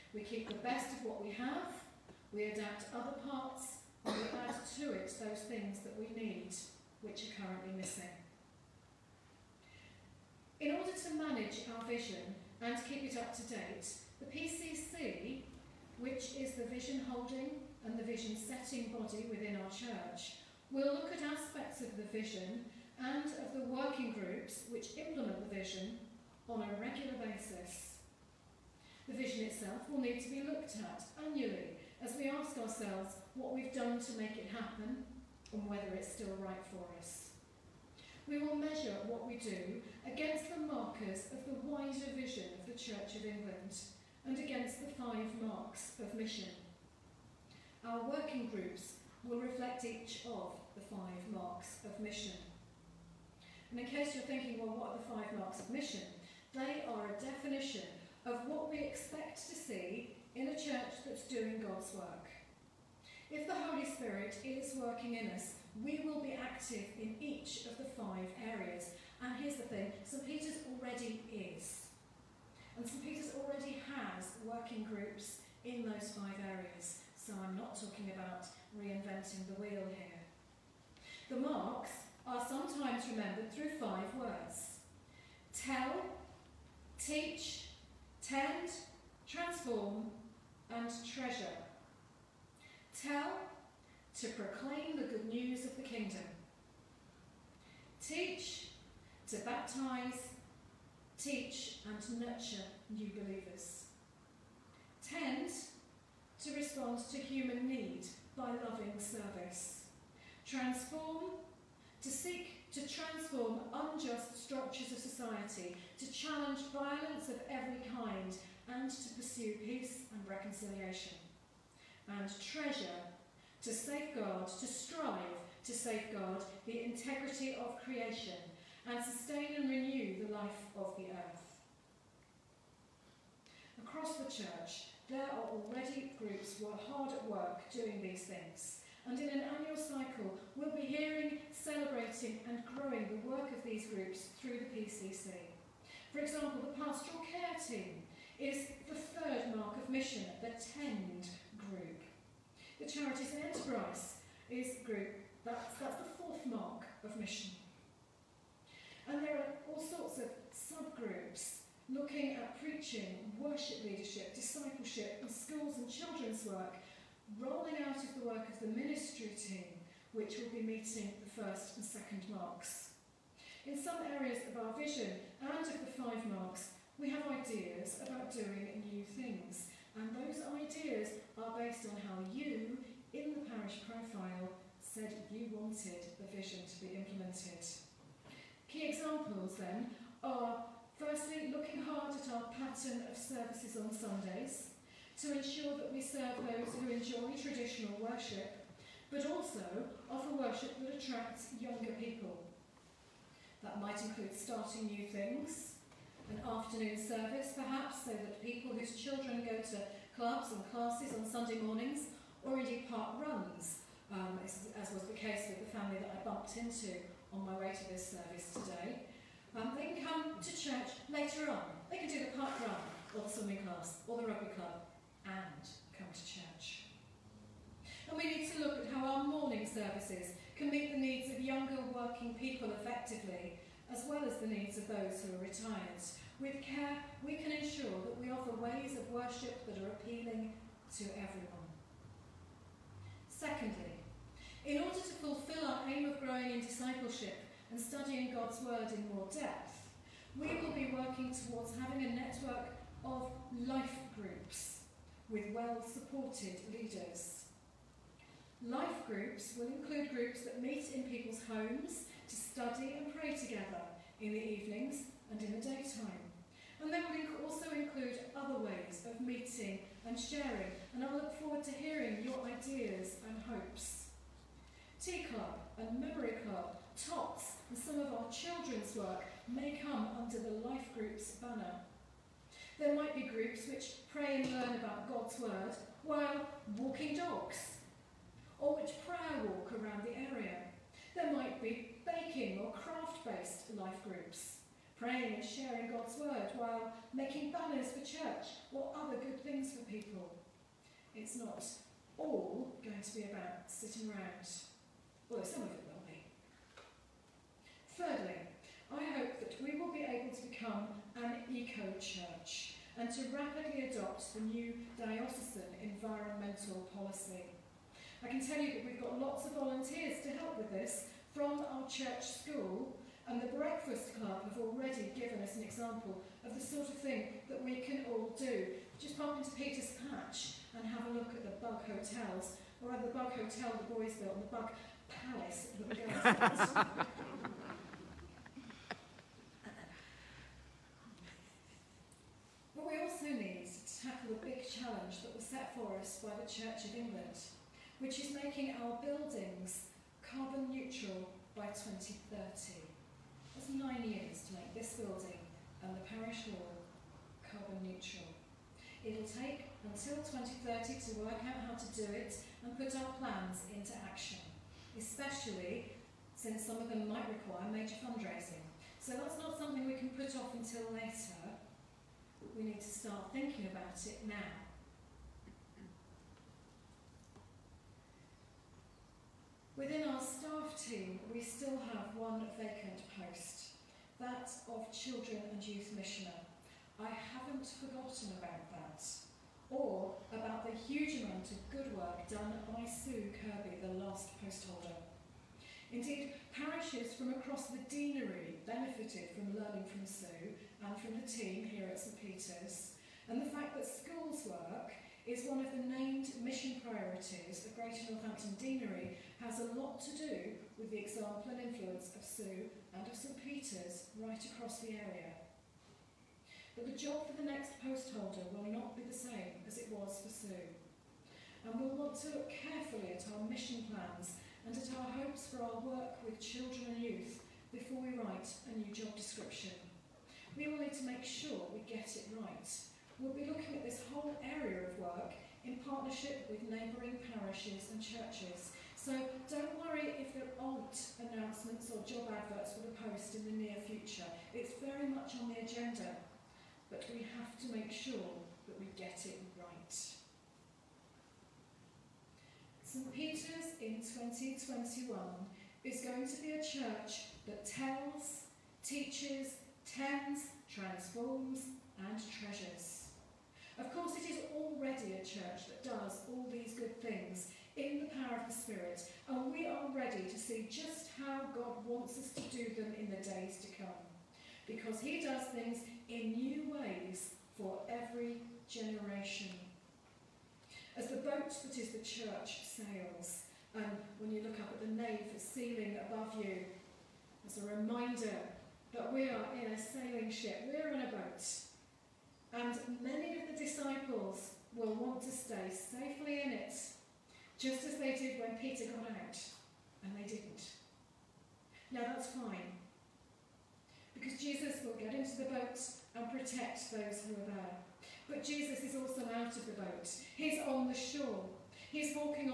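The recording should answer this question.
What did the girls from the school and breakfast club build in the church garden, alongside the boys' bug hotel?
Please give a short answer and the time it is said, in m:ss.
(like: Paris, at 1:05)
Bug palace, at 5:34.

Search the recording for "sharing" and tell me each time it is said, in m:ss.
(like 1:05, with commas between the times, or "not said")
4:30, 4:55.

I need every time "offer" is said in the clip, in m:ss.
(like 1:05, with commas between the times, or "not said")
3:20, 3:58.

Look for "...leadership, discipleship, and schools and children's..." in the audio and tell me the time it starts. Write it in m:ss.
2:43.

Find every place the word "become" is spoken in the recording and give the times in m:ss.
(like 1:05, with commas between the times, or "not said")
5:10.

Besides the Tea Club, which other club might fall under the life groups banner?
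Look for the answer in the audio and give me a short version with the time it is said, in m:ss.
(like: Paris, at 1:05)
Memory Club, at 4:35.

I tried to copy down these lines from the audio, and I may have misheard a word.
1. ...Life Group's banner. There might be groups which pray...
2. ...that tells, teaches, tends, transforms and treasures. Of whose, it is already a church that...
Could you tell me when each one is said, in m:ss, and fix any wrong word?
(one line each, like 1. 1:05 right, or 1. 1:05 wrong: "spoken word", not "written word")
1. 4:40 right
2. 7:37 wrong: "course", not "whose".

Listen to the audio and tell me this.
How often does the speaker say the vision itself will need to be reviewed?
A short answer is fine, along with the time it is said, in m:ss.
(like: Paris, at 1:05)
Annually, at 0:31.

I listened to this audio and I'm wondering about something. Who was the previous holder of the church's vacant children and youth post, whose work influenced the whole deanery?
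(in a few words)
Sue Kirby.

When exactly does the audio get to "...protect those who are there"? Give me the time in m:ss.
8:26.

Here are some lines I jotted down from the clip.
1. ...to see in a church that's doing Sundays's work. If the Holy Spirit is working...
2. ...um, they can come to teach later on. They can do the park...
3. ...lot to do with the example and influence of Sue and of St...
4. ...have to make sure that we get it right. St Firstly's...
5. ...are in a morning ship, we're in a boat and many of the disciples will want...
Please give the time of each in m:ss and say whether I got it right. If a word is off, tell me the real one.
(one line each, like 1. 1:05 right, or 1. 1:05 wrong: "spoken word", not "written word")
1. 0:59 wrong: "God", not "Sundays"
2. 3:39 wrong: "church", not "teach"
3. 6:49 right
4. 7:27 wrong: "Peter", not "Firstly"
5. 8:09 wrong: "sailing", not "morning".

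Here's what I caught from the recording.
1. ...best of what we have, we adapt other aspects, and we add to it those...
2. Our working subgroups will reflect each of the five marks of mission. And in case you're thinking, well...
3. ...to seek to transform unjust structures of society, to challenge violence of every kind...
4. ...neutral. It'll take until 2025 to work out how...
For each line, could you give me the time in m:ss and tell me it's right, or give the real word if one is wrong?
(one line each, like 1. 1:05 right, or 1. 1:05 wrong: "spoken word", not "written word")
1. 0:00 wrong: "parts", not "aspects"
2. 0:47 wrong: "groups", not "subgroups"
3. 1:52 right
4. 5:57 wrong: "2030", not "2025".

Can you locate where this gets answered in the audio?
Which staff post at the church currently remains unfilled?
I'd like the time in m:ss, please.
6:24.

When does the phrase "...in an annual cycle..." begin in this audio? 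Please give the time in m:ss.
2:19.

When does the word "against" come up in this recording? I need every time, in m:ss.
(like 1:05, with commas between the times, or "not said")
0:40, 0:44.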